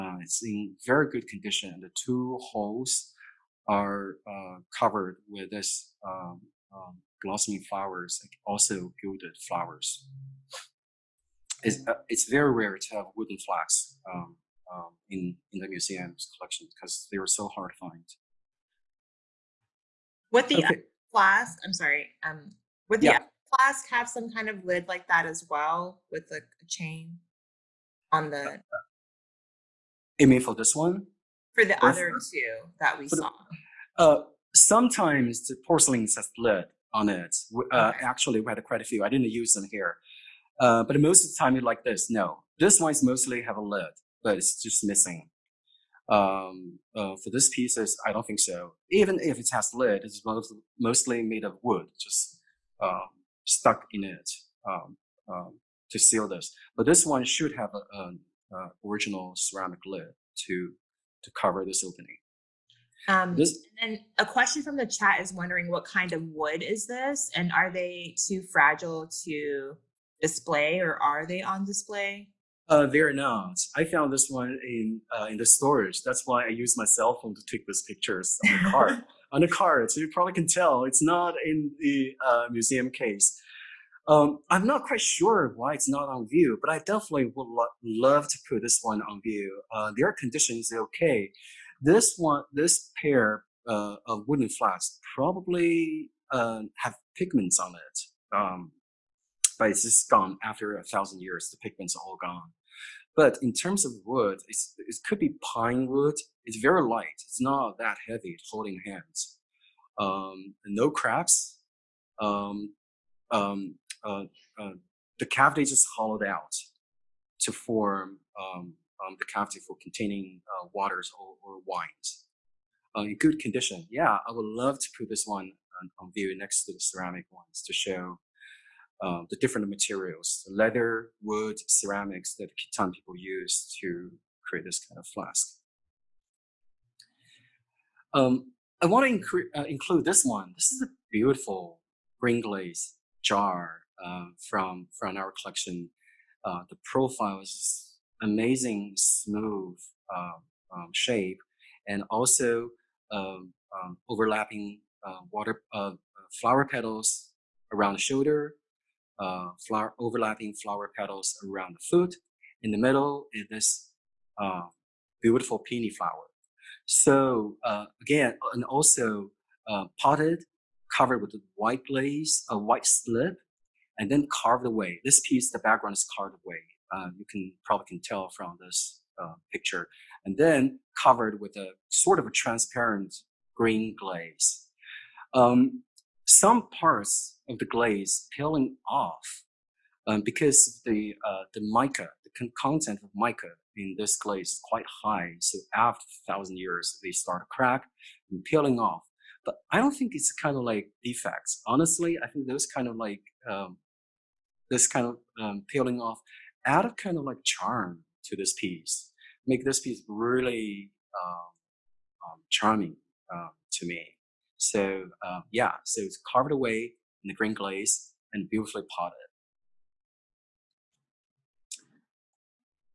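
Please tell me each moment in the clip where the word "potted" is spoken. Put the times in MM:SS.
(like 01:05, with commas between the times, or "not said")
02:49, 03:38.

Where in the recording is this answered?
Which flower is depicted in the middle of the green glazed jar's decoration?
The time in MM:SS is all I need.
02:45.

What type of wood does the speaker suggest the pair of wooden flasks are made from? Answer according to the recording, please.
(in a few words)
Pine wood.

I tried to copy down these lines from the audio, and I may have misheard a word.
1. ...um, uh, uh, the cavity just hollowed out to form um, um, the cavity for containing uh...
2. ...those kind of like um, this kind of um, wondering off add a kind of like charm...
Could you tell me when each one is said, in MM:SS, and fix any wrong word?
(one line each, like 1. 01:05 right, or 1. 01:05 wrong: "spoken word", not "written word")
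1. 01:53 right
2. 03:22 wrong: "peeling", not "wondering".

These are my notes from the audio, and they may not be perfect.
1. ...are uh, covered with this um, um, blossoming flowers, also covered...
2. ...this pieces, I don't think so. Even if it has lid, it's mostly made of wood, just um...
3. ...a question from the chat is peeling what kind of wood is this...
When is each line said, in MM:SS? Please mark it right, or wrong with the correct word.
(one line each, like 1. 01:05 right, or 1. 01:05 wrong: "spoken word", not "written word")
1. 00:03 wrong: "gilded", not "covered"
2. 00:47 right
3. 01:04 wrong: "wondering", not "peeling".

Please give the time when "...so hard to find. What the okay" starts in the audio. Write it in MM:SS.
00:17.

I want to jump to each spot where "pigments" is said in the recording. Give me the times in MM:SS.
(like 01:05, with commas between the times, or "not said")
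01:37, 01:41.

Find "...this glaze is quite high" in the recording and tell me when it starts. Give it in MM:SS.
03:13.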